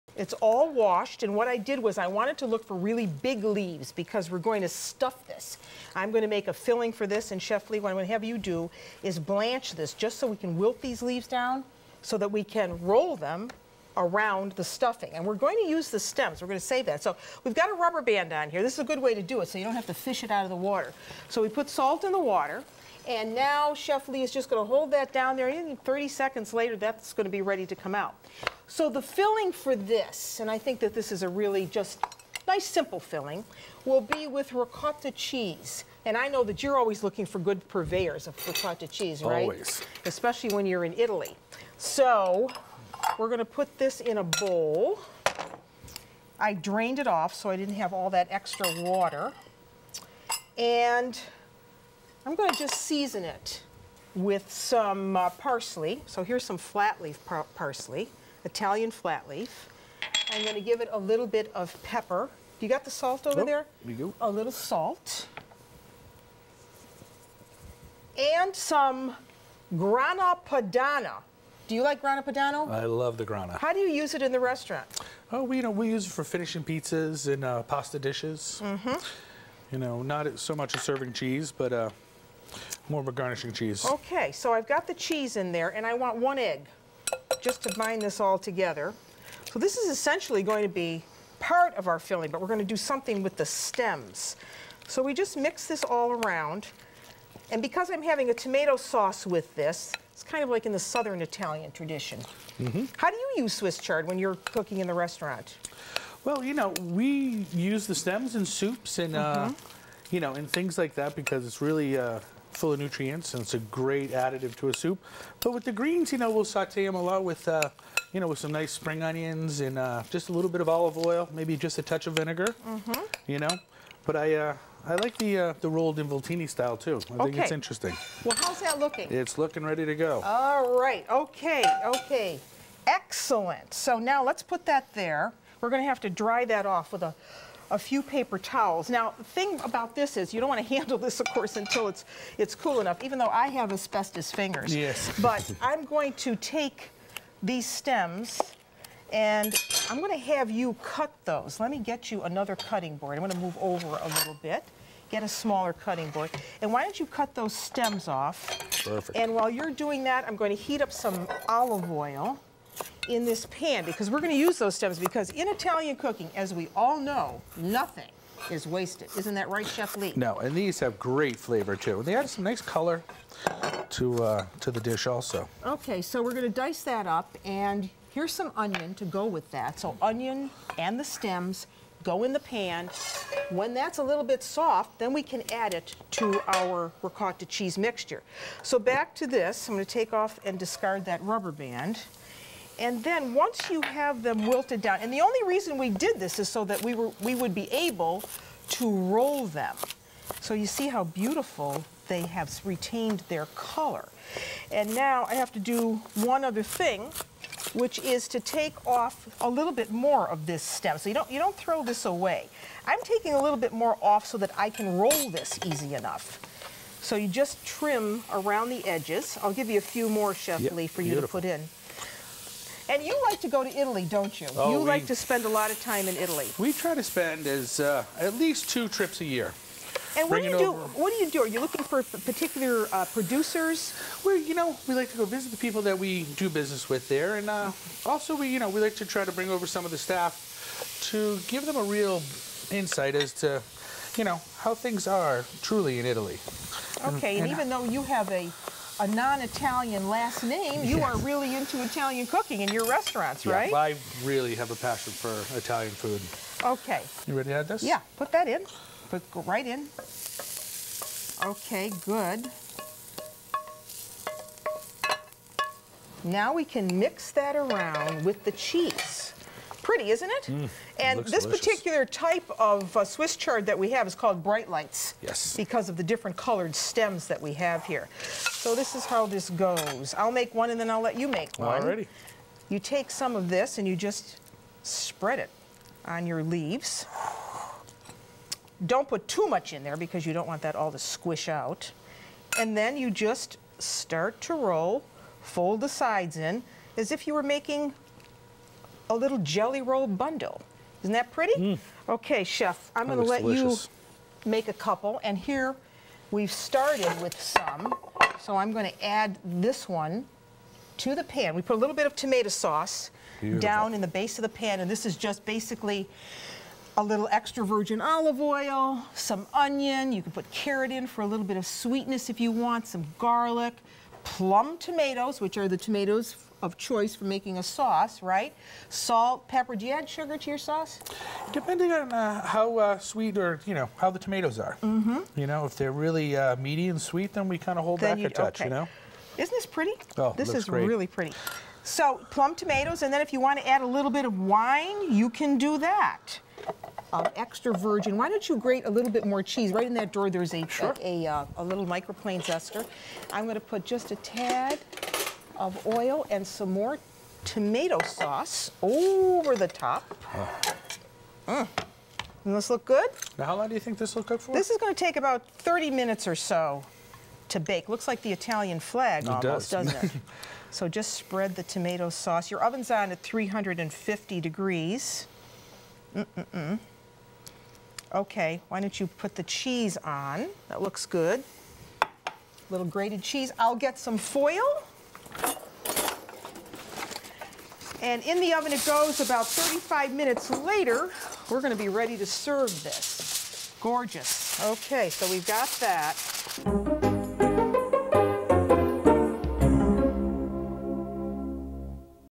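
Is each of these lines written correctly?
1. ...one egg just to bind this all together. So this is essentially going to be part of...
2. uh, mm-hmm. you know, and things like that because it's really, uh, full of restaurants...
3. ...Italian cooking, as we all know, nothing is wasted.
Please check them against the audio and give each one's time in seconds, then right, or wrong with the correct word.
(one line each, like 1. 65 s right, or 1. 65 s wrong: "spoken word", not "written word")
1. 86 s right
2. 109 s wrong: "nutrients", not "restaurants"
3. 165 s right.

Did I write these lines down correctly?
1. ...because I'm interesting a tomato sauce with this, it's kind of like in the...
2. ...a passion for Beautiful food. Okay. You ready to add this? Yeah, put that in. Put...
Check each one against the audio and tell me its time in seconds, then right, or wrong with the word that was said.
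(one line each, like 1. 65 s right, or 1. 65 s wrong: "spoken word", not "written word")
1. 97 s wrong: "having", not "interesting"
2. 254 s wrong: "Italian", not "Beautiful".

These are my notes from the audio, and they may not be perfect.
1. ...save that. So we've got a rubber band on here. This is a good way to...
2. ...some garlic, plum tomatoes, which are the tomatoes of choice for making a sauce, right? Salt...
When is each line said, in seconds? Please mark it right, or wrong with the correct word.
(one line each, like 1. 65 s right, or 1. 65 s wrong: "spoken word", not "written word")
1. 16 s right
2. 322 s right.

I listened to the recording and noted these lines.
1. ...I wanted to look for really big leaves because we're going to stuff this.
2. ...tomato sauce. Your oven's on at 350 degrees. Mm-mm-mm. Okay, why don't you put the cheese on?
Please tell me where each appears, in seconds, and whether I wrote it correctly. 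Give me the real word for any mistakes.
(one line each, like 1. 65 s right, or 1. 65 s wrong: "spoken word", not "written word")
1. 1 s right
2. 371 s right.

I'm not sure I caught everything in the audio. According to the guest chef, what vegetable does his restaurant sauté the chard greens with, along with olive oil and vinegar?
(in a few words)
Spring onions.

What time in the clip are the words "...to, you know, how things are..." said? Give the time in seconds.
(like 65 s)
243 s.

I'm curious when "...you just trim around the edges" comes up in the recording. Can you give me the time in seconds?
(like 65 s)
217 s.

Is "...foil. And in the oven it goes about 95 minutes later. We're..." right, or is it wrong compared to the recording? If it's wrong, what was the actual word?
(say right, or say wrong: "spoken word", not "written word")
wrong: "35", not "95".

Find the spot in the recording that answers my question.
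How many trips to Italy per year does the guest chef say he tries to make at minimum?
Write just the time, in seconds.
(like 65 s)
228 s.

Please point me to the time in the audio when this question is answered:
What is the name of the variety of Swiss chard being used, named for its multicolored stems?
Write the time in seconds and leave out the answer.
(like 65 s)
274 s.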